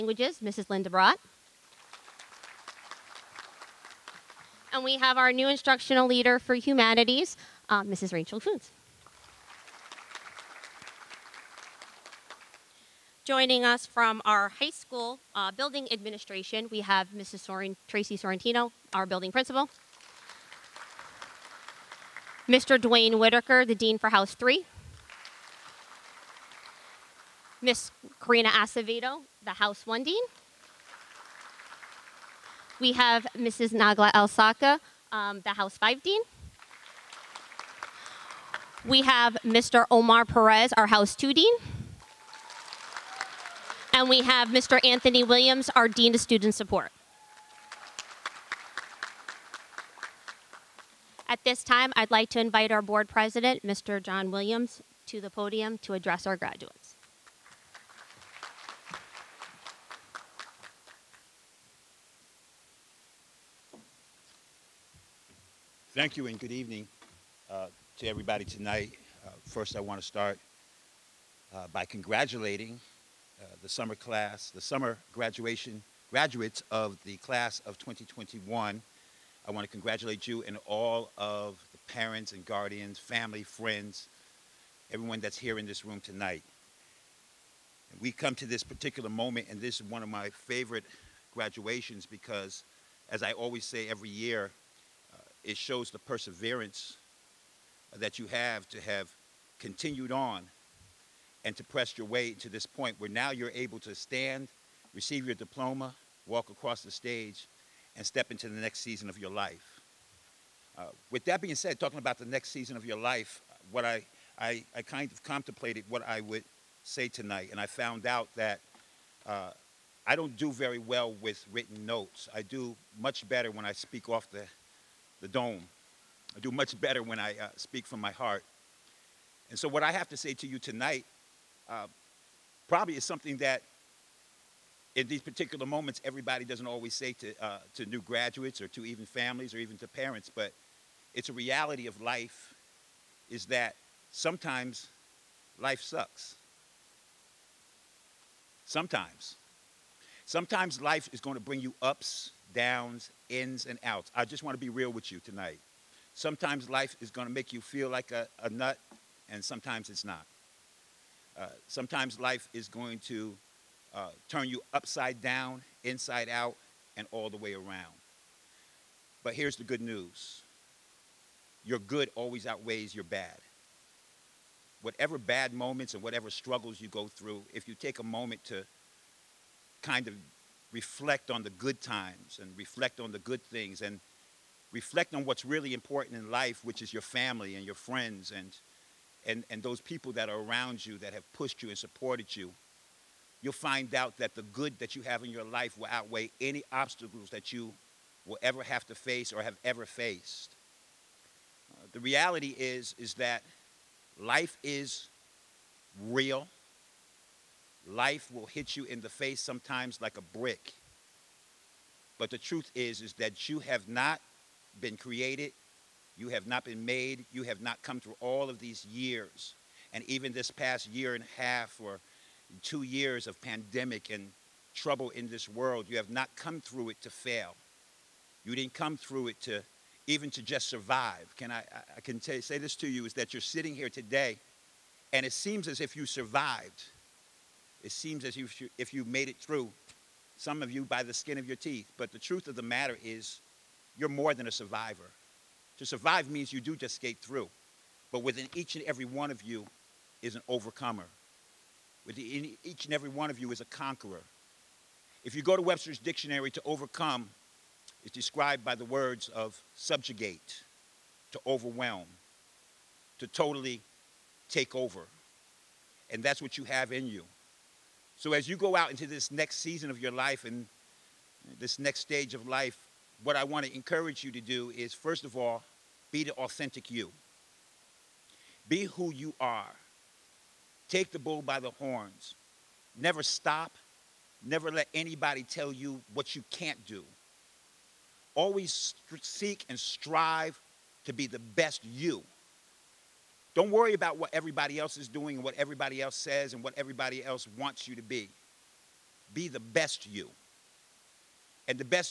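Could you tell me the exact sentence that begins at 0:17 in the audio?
Soren, Tracy Sorrentino, our building principal.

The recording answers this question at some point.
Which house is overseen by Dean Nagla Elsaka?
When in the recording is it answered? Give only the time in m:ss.
0:35.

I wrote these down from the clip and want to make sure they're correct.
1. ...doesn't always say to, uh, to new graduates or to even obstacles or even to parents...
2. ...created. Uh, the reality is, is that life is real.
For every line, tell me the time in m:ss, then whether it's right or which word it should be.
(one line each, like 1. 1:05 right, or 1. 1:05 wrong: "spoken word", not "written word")
1. 2:16 wrong: "families", not "obstacles"
2. 3:19 wrong: "faced", not "created".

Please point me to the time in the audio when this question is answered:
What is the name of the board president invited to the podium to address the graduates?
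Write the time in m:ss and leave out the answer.
0:53.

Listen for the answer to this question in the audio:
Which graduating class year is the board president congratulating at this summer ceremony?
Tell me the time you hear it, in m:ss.
1:17.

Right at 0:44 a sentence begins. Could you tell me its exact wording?
Anthony Williams, our Dean of Student Support.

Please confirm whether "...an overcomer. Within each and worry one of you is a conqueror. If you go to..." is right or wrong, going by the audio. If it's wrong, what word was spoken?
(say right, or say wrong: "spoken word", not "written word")
wrong: "every", not "worry".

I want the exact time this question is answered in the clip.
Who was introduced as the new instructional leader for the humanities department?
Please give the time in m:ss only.
0:07.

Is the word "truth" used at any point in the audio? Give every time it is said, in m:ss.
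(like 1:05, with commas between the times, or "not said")
3:32, 4:02.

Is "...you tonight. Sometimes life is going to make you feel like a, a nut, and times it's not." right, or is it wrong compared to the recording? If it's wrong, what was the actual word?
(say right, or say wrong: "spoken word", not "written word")
wrong: "sometimes", not "times".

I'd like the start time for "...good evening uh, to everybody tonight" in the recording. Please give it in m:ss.
1:06.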